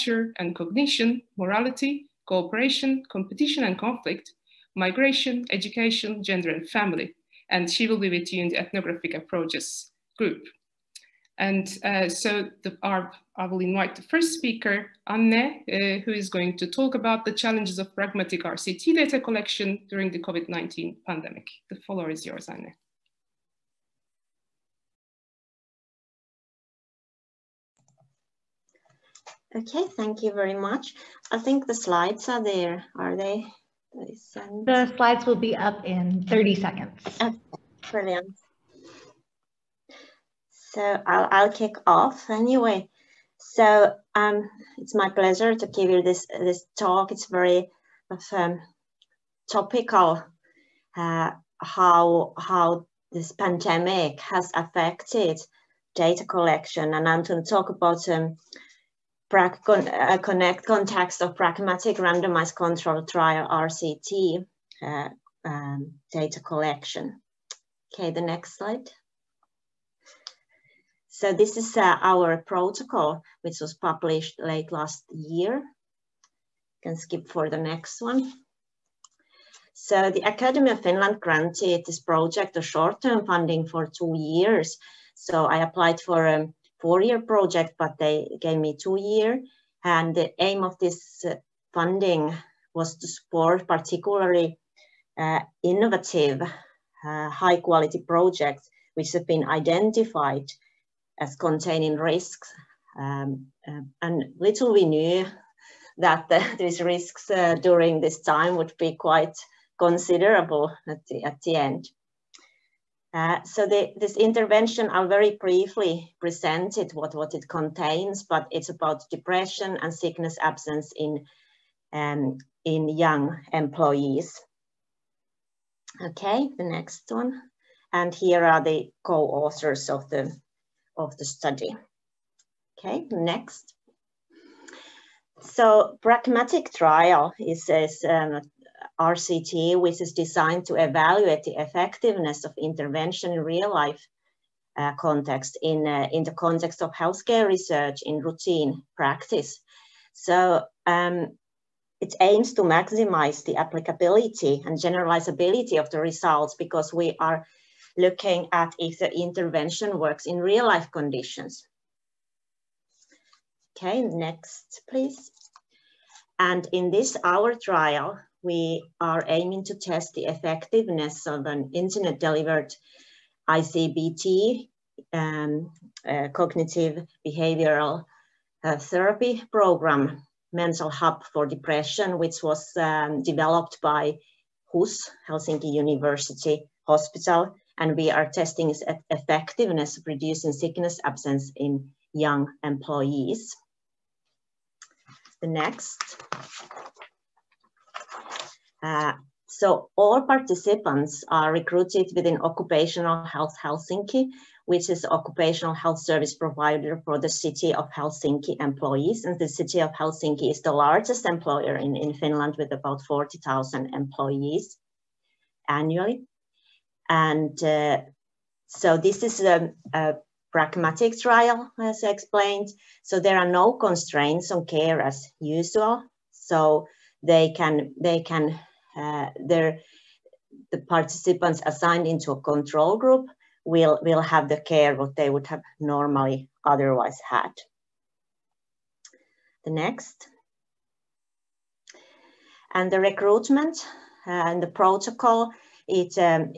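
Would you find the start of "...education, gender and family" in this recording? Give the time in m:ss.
0:05.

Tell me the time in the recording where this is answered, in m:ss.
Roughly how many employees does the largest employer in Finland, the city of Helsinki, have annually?
3:33.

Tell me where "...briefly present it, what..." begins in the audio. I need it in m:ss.
1:55.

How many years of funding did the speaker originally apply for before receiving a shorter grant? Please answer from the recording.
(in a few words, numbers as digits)
4.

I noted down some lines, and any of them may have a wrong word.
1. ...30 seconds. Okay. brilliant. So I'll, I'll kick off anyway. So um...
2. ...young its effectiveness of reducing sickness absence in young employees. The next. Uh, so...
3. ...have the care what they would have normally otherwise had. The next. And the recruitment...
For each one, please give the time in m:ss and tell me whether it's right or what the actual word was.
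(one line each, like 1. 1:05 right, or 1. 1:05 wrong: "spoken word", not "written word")
1. 0:36 right
2. 3:08 wrong: "testing", not "young"
3. 3:54 right.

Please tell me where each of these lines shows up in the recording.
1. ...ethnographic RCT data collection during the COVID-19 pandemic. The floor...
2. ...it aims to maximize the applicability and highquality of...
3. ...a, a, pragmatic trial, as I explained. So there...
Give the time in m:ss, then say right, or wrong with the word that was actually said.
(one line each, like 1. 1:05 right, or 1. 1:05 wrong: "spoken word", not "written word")
1. 0:17 wrong: "pragmatic", not "ethnographic"
2. 2:32 wrong: "generalizability", not "highquality"
3. 3:39 right.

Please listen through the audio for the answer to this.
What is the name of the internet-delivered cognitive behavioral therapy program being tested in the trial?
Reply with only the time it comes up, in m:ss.
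3:00.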